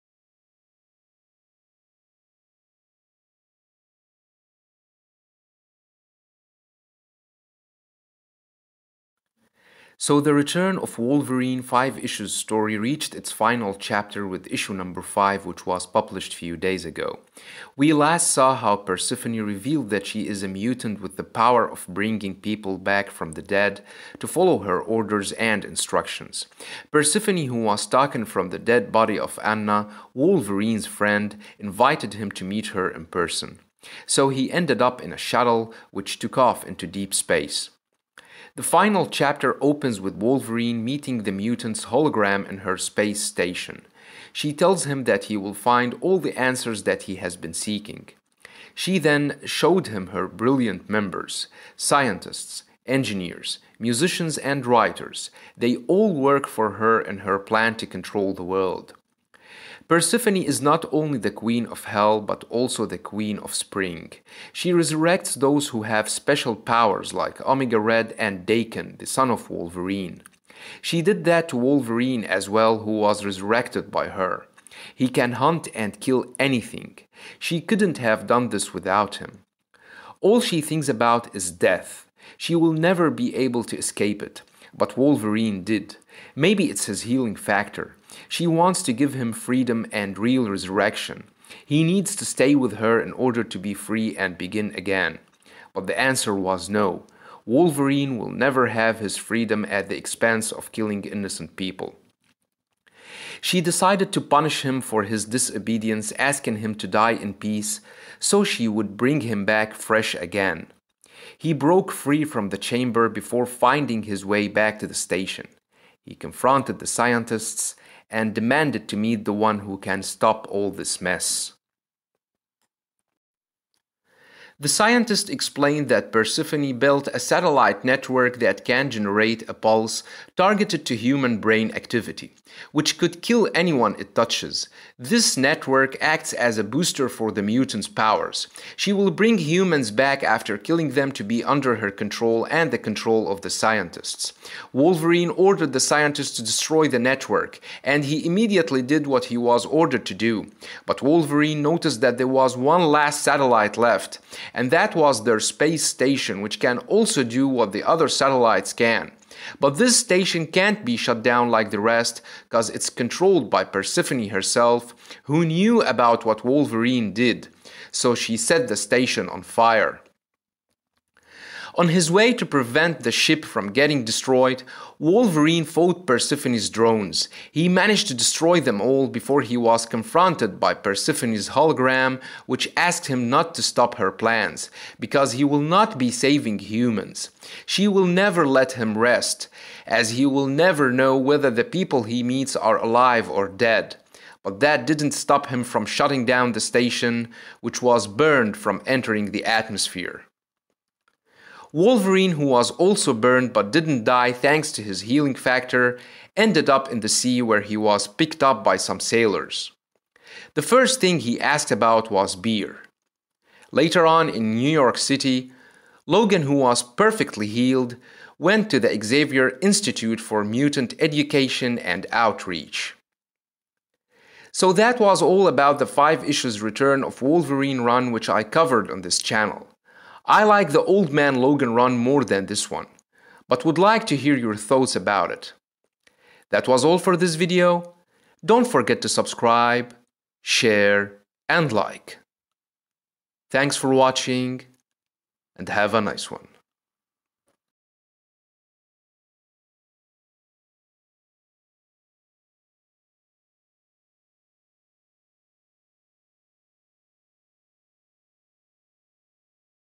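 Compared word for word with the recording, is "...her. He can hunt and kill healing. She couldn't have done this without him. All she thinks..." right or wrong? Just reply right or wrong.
wrong.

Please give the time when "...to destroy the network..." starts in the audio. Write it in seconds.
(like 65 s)
146 s.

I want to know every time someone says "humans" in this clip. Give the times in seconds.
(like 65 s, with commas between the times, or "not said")
130 s, 139 s, 186 s.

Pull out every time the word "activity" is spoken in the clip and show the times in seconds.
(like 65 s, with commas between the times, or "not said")
131 s.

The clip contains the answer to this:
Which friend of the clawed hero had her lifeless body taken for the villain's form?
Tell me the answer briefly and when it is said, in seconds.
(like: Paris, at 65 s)
Anna, at 29 s.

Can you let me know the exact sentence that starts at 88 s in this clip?
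She wants to give him freedom and real resurrection.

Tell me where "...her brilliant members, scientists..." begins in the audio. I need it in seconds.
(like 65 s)
50 s.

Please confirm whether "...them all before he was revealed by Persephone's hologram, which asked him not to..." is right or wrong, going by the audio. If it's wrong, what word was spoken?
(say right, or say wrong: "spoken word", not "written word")
wrong: "confronted", not "revealed".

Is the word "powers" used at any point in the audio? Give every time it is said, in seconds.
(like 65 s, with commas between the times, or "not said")
21 s, 66 s, 137 s.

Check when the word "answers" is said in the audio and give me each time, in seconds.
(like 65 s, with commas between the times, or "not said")
46 s, 95 s.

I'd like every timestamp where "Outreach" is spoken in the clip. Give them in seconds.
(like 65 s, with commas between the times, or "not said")
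222 s.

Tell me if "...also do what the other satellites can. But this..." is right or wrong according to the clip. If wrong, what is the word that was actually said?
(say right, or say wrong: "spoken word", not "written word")
right.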